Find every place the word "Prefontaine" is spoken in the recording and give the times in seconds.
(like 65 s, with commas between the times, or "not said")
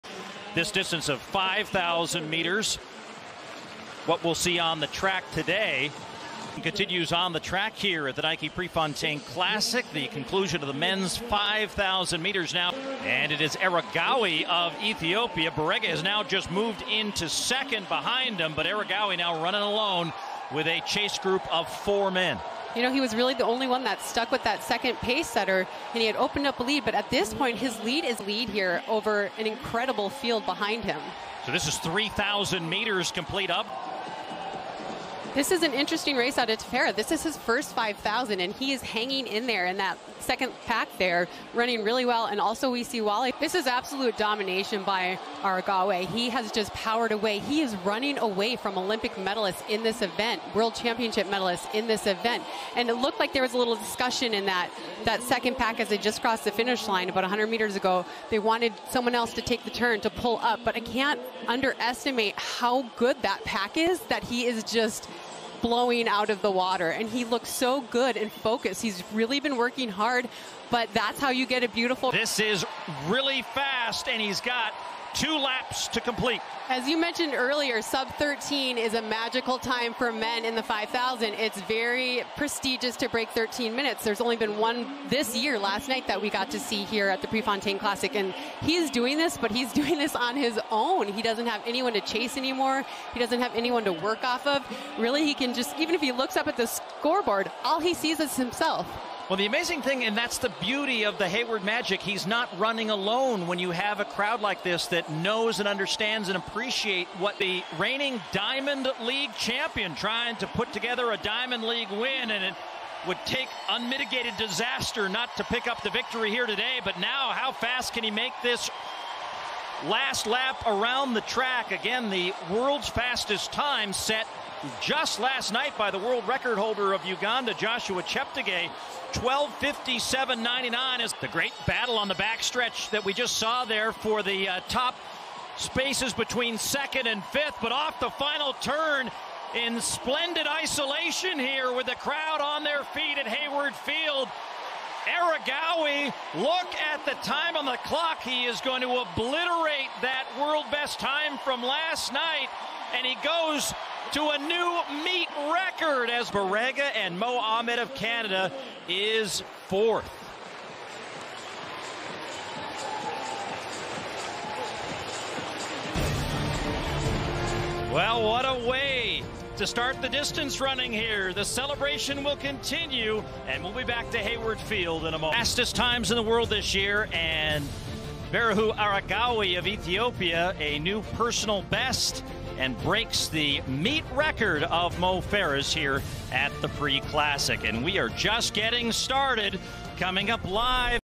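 8 s, 87 s.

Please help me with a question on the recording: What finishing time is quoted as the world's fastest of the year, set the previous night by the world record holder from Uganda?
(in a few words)
12:57.99.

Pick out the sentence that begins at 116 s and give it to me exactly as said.
But now, how fast can he make this Last lap around the track.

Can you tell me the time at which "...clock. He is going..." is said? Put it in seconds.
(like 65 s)
147 s.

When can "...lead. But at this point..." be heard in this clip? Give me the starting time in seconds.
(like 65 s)
26 s.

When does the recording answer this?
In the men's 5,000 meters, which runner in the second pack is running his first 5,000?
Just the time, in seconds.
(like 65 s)
36 s.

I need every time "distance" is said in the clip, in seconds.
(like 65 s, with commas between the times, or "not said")
0 s, 170 s.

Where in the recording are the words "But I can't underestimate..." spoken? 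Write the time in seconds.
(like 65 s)
60 s.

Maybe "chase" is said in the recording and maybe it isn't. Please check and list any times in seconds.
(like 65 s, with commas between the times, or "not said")
20 s, 92 s.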